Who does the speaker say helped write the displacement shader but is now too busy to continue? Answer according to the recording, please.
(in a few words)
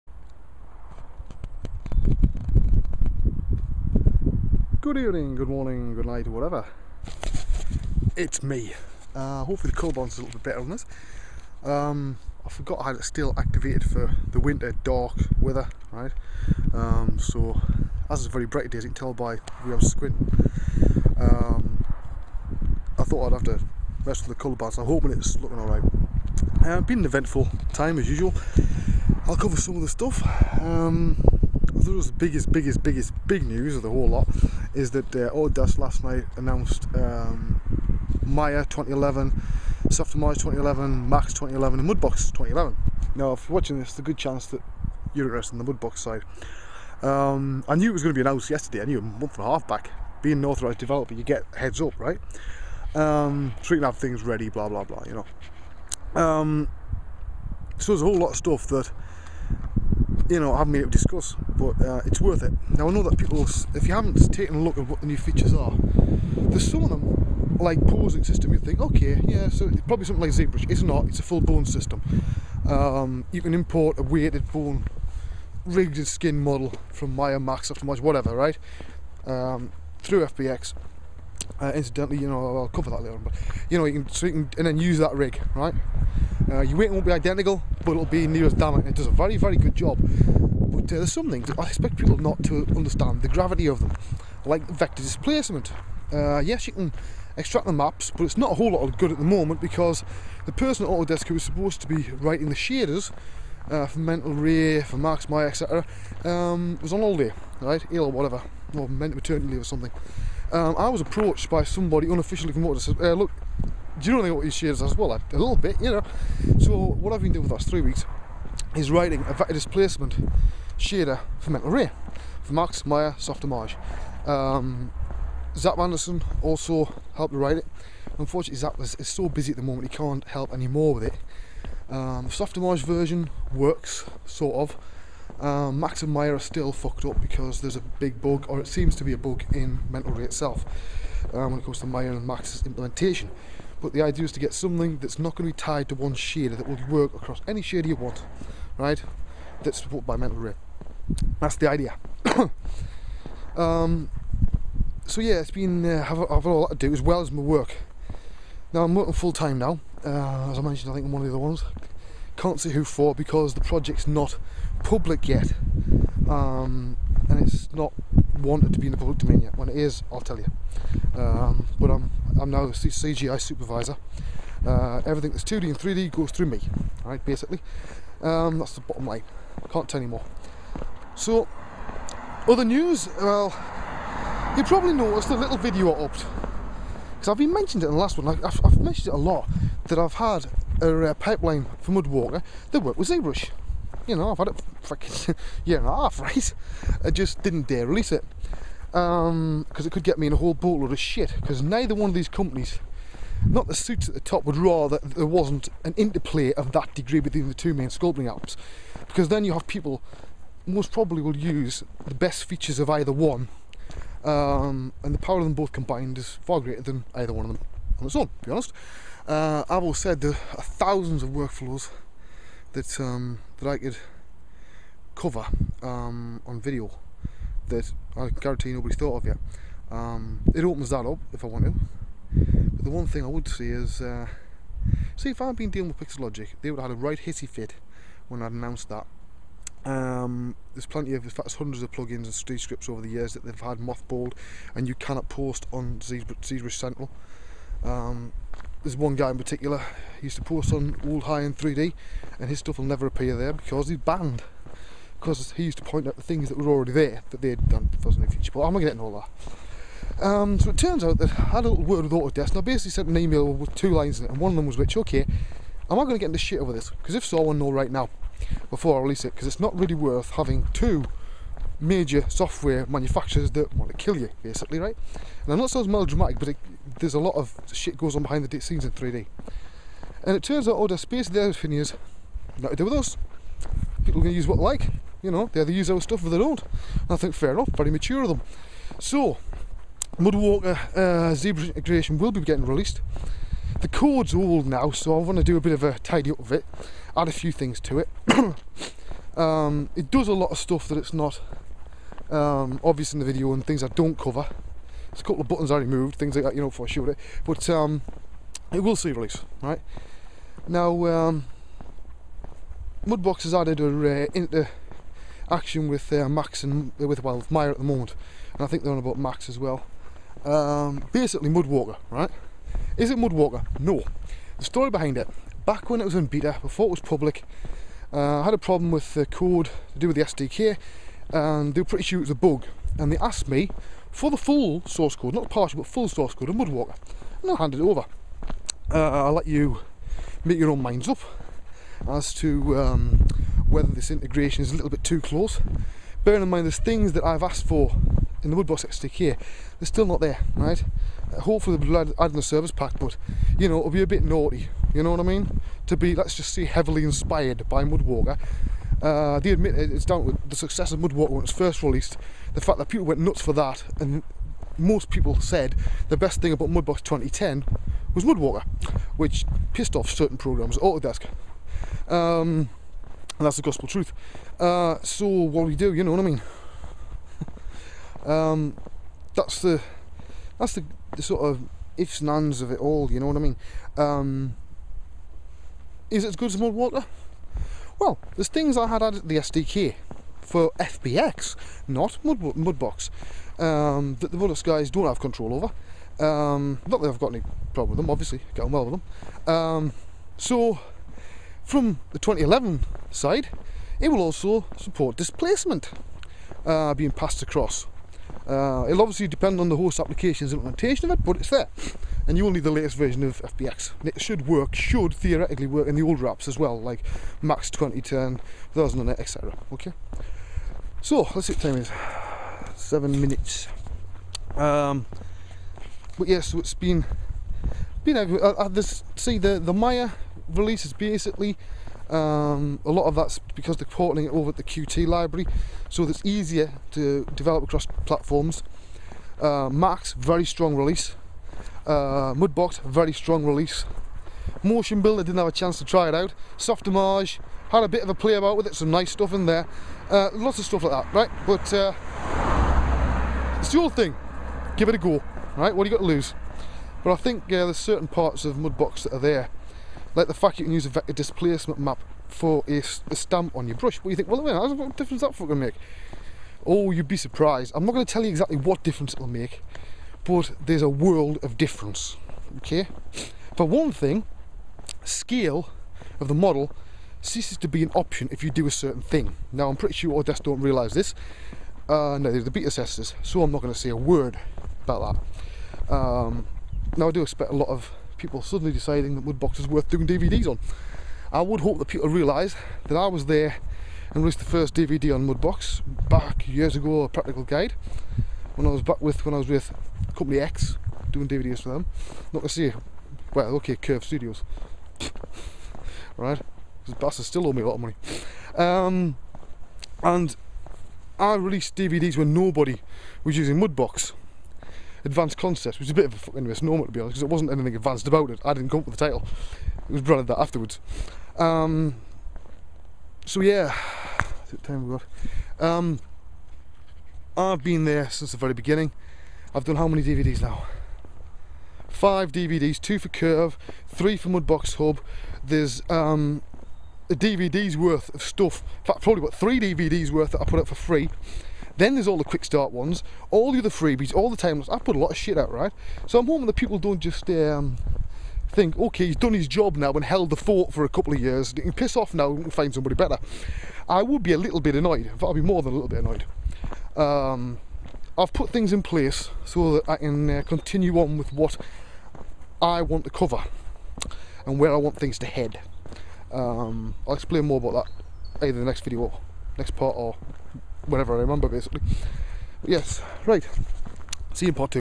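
Zap Anderson.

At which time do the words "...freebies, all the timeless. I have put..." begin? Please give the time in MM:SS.
09:03.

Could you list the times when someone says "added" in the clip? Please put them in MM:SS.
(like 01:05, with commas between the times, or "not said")
05:13, 06:29.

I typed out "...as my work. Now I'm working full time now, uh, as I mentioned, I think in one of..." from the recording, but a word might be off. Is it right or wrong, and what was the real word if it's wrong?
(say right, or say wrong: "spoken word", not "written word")
right.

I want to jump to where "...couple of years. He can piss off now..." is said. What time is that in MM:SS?
09:10.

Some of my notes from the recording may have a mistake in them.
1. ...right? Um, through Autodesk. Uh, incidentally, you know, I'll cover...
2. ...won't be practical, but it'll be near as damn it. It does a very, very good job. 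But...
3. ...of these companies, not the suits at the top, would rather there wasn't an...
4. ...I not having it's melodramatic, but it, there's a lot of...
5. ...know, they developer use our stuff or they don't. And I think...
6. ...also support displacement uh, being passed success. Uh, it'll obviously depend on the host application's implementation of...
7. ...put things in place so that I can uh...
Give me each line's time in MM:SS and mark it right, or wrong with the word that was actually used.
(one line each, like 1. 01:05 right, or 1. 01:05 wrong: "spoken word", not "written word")
1. 01:18 wrong: "FBX", not "Autodesk"
2. 01:26 wrong: "identical", not "practical"
3. 03:22 right
4. 04:35 wrong: "saying", not "having"
5. 04:45 wrong: "either", not "developer"
6. 06:44 wrong: "across", not "success"
7. 09:18 right.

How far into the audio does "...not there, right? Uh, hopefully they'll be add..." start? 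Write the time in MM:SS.
05:50.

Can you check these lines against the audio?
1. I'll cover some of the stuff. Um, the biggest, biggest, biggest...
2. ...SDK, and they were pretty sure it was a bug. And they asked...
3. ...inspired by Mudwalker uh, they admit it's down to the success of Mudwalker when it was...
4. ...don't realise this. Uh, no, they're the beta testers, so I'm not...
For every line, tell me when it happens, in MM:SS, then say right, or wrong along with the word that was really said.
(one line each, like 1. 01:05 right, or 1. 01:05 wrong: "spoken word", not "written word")
1. 00:29 right
2. 05:30 right
3. 05:57 right
4. 08:00 right.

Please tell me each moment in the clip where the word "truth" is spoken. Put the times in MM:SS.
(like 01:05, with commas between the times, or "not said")
06:13.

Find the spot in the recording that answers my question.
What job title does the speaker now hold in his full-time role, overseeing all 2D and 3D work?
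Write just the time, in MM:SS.
02:52.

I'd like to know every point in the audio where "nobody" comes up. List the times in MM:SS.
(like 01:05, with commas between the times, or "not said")
03:48, 08:32.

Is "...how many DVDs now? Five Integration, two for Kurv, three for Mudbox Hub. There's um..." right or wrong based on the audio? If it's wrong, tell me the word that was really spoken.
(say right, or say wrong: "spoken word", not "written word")
wrong: "DVDs", not "Integration".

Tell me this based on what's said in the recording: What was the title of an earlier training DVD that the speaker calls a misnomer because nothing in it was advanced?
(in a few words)
Advanced Concepts.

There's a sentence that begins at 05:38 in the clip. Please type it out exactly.
Uh, I'll let you make your own minds up as to um, whether this integration is a little bit too close.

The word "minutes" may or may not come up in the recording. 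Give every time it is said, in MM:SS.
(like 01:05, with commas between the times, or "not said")
07:03, 07:44.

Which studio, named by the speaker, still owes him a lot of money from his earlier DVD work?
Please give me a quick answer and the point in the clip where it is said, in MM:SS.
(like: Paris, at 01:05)
Kurv Studios, at 08:23.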